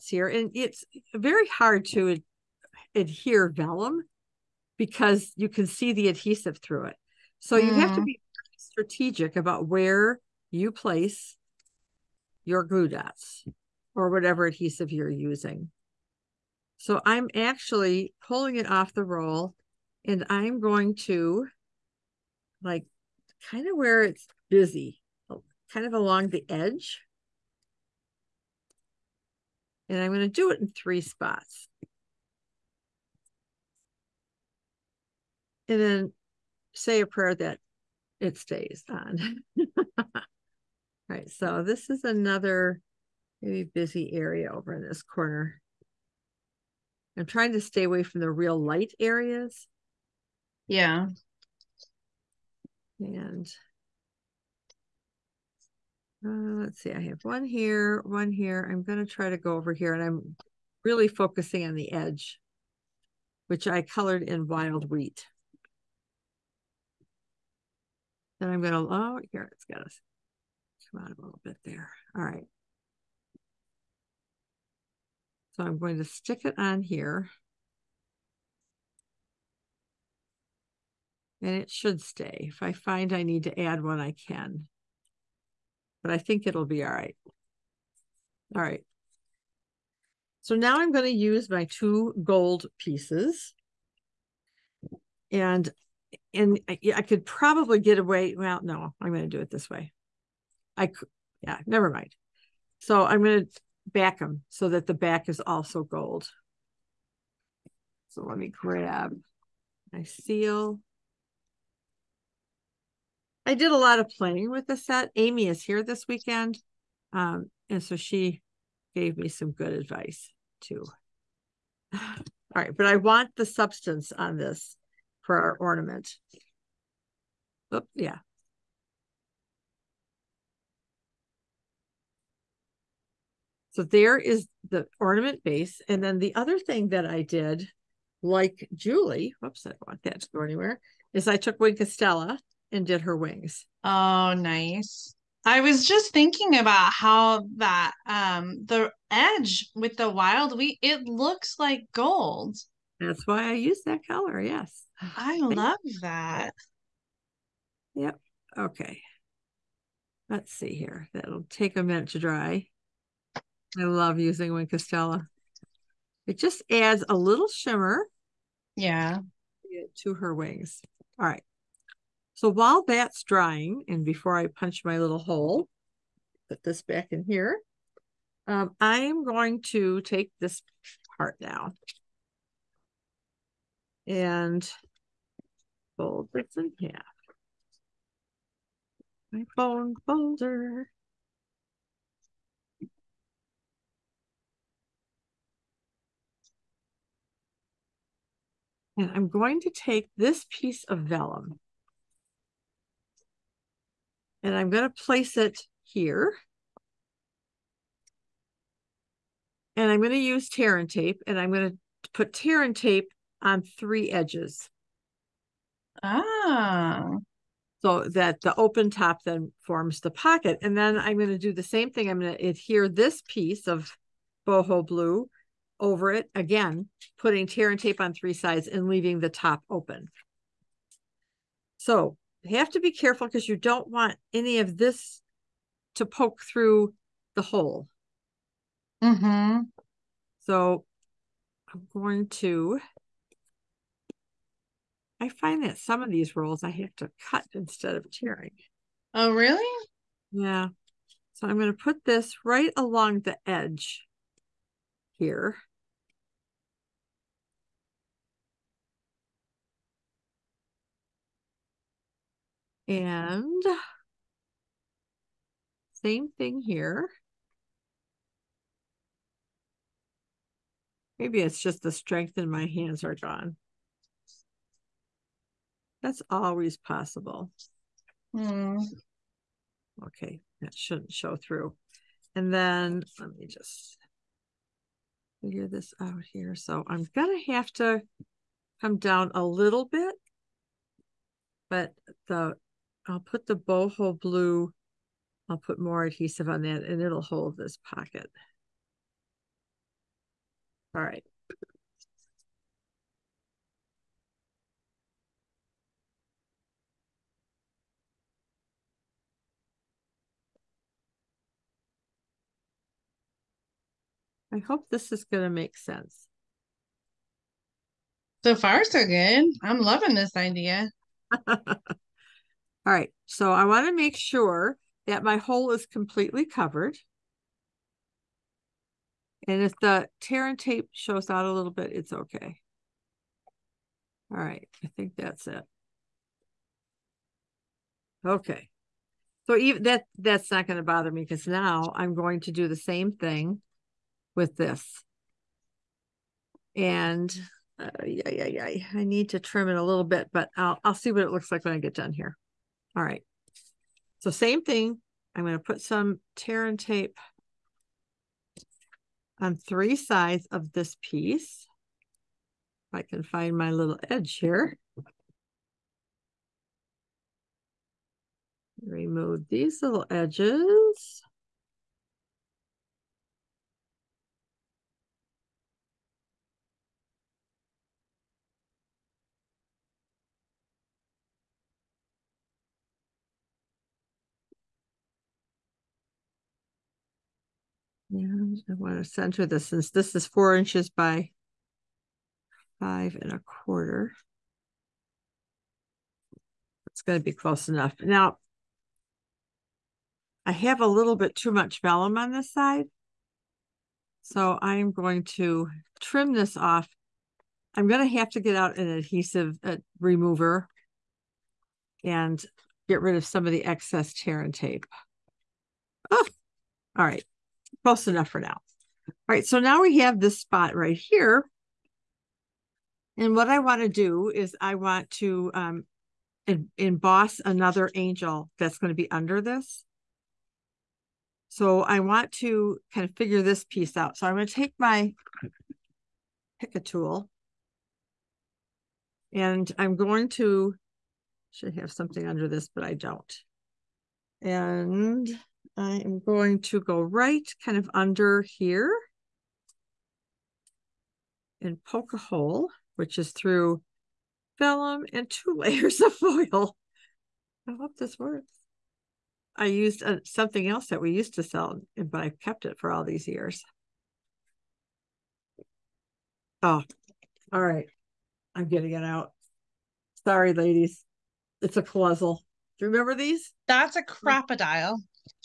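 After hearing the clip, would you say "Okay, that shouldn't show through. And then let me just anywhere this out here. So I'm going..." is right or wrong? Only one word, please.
wrong.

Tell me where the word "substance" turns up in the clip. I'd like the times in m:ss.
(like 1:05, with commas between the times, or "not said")
2:03.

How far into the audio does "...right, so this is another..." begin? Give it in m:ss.
0:41.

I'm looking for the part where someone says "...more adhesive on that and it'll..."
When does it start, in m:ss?
4:55.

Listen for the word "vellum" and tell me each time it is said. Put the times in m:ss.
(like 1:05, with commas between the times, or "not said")
0:03, 3:20, 6:41, 7:34.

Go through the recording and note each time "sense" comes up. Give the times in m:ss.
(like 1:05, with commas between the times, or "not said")
5:15.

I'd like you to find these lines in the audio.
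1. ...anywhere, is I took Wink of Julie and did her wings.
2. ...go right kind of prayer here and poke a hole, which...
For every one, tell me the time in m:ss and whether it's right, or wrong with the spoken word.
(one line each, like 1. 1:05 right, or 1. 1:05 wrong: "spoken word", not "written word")
1. 2:20 wrong: "Stella", not "Julie"
2. 7:26 wrong: "under", not "prayer".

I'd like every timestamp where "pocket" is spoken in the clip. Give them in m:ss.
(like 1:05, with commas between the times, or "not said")
3:40, 4:57.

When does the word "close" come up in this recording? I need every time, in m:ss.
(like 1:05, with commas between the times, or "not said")
6:37, 6:57.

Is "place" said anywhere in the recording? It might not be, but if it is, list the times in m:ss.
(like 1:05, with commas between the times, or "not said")
0:10, 3:25.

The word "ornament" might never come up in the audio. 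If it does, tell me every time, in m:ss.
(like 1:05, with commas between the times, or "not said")
2:05, 2:14.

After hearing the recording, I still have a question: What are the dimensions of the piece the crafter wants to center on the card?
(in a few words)
4 by 5 1/4 inches.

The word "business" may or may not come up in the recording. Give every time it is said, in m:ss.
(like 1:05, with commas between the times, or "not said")
not said.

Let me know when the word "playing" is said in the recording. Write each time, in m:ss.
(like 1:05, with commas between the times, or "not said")
1:54.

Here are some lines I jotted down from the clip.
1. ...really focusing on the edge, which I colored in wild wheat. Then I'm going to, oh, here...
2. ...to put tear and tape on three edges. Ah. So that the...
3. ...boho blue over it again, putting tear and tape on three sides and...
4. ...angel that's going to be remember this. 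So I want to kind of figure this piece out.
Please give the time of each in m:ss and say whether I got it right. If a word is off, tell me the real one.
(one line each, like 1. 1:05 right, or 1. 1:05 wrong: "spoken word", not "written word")
1. 1:00 right
2. 3:31 right
3. 3:44 right
4. 7:07 wrong: "under", not "remember".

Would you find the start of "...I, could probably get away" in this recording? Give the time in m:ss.
1:36.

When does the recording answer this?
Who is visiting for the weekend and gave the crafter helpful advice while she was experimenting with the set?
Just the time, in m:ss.
1:55.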